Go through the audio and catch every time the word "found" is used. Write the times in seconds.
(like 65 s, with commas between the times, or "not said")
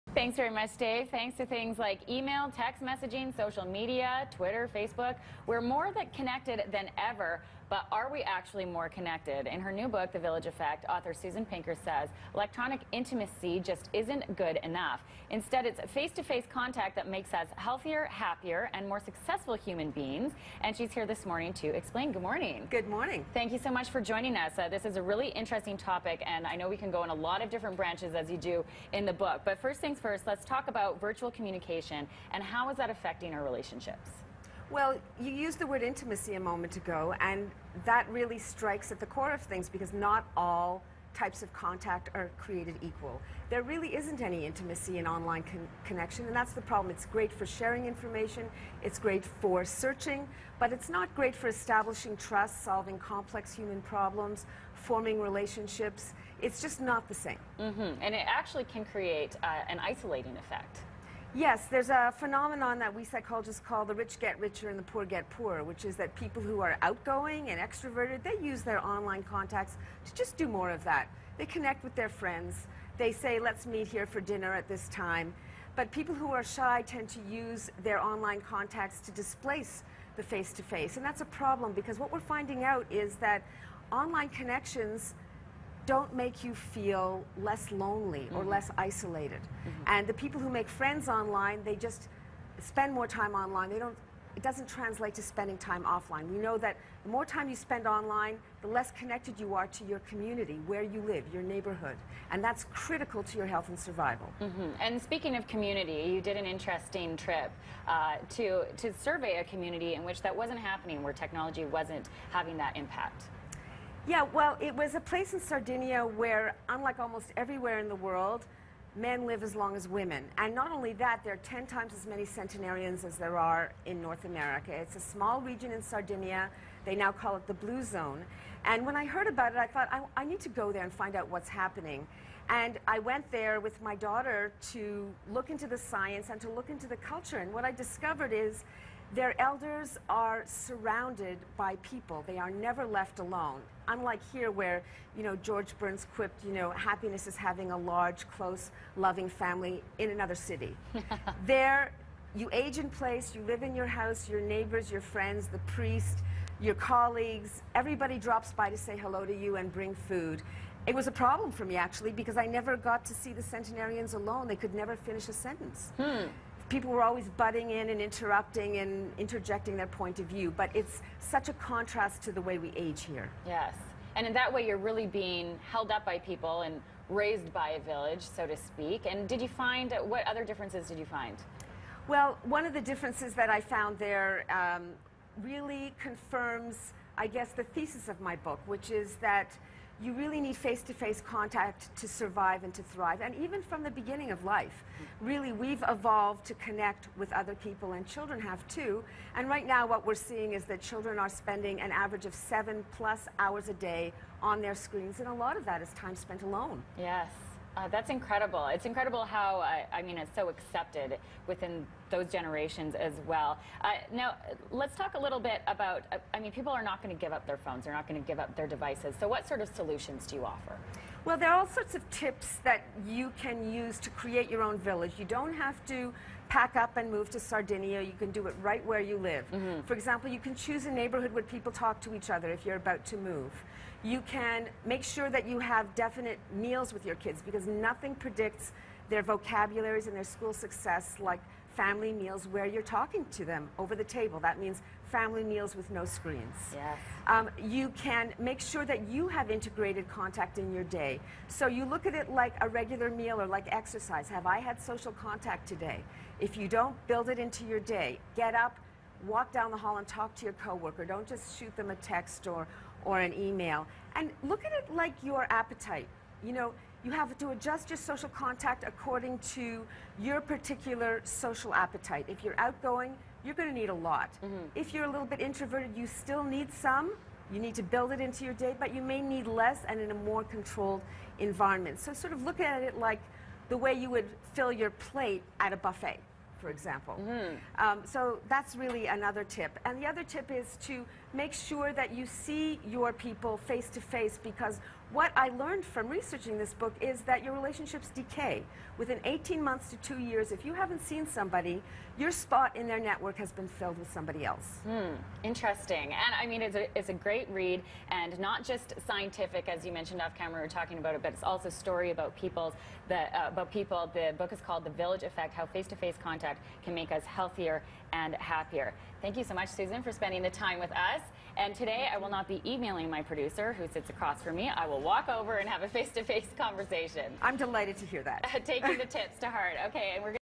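183 s.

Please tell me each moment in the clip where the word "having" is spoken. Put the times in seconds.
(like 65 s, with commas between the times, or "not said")
112 s, 147 s.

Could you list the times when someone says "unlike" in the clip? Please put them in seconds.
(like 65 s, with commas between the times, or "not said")
116 s, 143 s.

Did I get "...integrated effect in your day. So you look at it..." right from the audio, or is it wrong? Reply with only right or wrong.
wrong.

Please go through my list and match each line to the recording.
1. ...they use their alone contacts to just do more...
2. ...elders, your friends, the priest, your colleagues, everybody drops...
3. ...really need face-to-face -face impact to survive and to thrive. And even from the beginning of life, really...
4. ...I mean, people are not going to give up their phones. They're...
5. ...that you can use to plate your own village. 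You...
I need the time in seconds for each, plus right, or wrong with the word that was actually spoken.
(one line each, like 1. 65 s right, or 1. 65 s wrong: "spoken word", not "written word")
1. 68 s wrong: "online", not "alone"
2. 154 s wrong: "neighbors", not "elders"
3. 190 s wrong: "contact", not "impact"
4. 216 s right
5. 222 s wrong: "create", not "plate".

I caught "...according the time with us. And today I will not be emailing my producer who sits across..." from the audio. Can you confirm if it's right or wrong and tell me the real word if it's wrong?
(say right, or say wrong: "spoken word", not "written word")
wrong: "spending", not "according".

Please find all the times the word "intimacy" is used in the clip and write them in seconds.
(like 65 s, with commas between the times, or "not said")
12 s, 35 s, 44 s.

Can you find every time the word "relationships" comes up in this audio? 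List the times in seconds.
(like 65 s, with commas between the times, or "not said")
33 s, 55 s, 297 s.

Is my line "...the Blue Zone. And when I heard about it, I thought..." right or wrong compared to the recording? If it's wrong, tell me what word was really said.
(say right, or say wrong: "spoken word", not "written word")
right.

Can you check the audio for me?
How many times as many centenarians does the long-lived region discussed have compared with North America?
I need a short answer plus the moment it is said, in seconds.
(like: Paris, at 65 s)
10, at 121 s.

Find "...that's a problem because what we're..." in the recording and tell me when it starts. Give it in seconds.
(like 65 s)
81 s.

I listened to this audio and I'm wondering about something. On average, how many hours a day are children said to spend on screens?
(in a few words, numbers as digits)
7 plus.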